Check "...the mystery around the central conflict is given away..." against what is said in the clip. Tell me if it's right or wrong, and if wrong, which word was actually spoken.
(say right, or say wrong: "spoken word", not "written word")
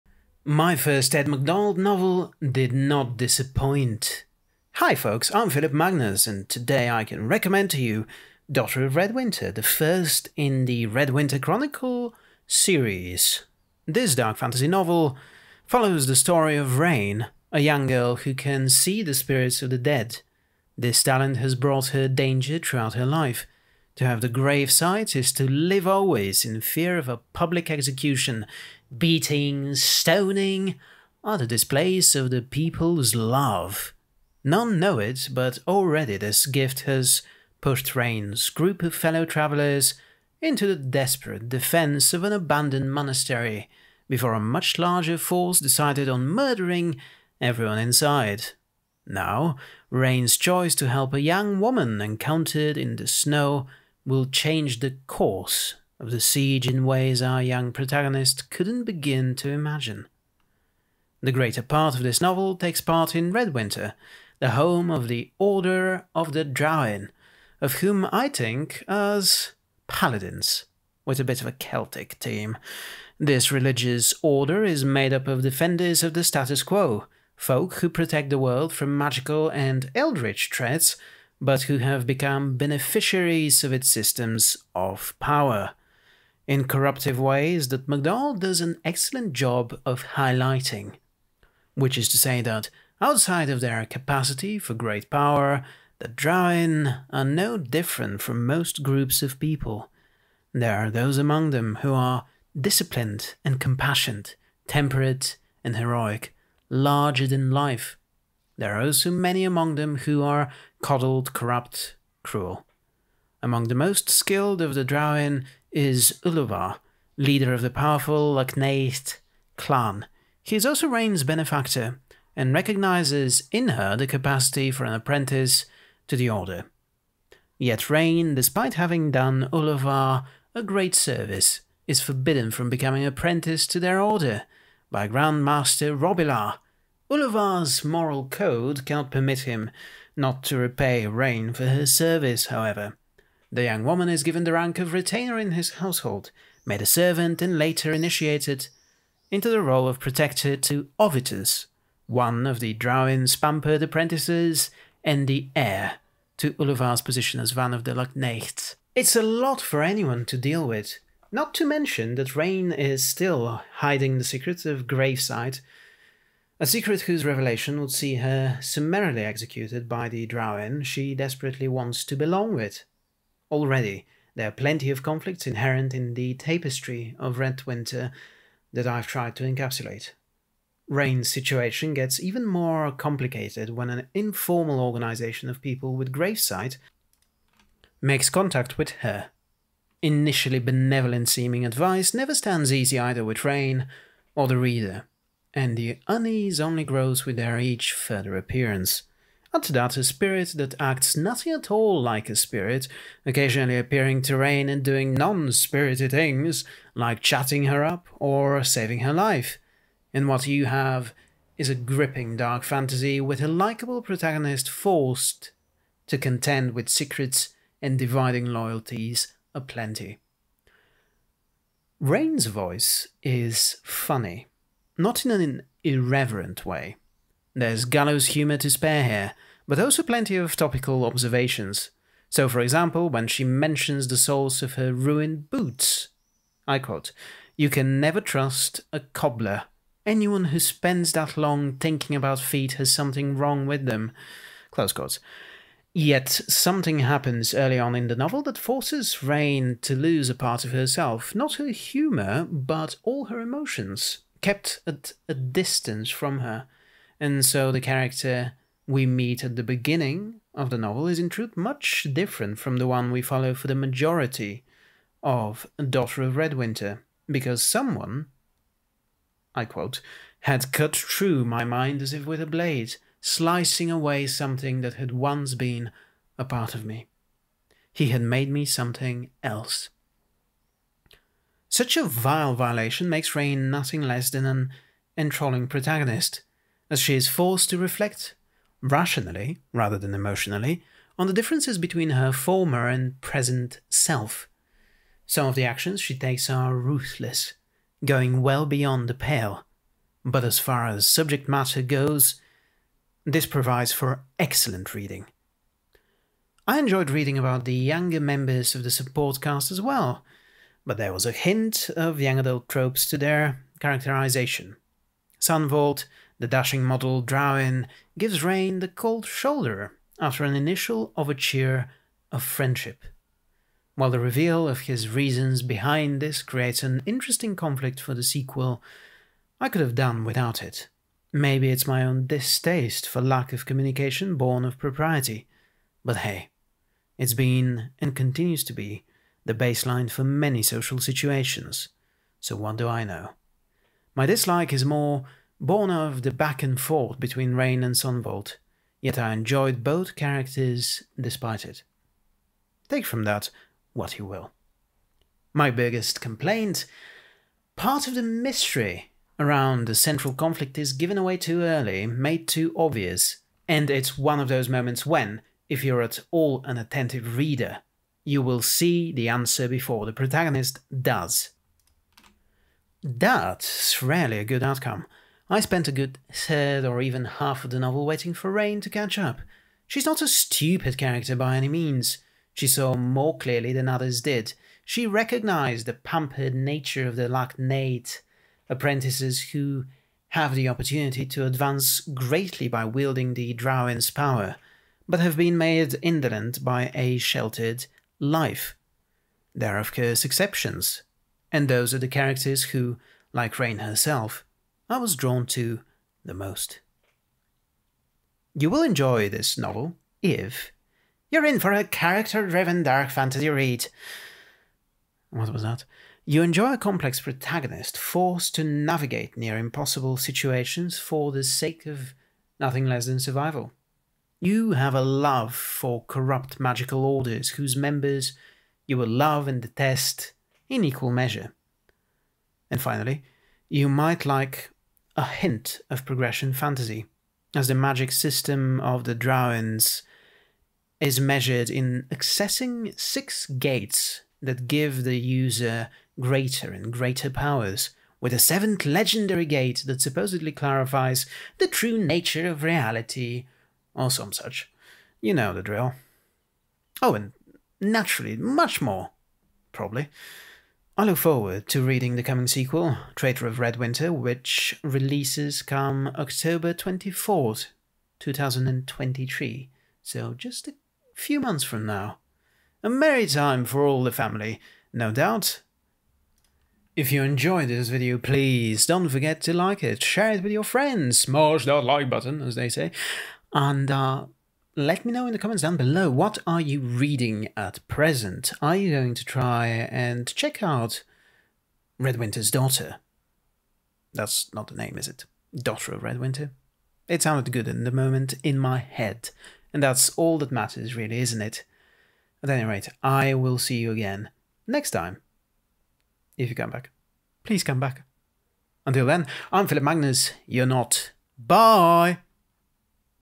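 right.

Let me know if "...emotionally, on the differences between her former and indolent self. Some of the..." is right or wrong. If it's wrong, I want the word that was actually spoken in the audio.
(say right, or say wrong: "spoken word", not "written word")
wrong: "present", not "indolent".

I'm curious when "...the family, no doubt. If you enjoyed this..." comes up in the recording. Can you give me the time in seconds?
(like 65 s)
474 s.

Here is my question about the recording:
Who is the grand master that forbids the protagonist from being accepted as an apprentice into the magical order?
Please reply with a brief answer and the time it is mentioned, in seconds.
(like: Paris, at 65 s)
Robilar, at 135 s.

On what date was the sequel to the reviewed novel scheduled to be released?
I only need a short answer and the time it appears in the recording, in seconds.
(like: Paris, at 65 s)
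October 24th, 2023, at 466 s.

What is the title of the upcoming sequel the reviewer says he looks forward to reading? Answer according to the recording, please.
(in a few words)
Traitor of Redwinter.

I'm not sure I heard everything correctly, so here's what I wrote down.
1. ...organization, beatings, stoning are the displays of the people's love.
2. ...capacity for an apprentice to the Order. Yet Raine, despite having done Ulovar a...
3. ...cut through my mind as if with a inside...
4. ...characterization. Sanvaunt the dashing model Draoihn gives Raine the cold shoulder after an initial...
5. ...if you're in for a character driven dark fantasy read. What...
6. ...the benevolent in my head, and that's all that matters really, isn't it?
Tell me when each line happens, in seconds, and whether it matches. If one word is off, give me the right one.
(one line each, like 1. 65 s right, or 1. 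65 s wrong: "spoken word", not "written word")
1. 27 s wrong: "execution", not "organization"
2. 124 s right
3. 270 s wrong: "blade", not "inside"
4. 313 s right
5. 410 s right
6. 497 s wrong: "moment", not "benevolent".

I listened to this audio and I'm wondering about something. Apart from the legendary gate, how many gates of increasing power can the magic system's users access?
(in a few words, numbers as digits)
6.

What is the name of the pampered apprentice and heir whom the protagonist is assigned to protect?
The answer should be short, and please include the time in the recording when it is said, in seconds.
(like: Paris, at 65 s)
Ovitus, at 150 s.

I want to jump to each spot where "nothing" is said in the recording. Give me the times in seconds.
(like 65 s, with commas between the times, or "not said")
201 s, 283 s, 422 s.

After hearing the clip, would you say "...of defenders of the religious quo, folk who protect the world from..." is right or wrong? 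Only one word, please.
wrong.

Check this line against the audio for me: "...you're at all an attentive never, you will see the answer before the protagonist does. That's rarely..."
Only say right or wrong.
wrong.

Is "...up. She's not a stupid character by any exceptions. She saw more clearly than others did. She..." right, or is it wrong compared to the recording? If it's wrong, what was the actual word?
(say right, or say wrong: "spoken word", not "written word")
wrong: "means", not "exceptions".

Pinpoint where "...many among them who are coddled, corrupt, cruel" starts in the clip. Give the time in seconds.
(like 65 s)
109 s.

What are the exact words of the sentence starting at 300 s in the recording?
But as far as subject matter goes, this provides for excellent reading.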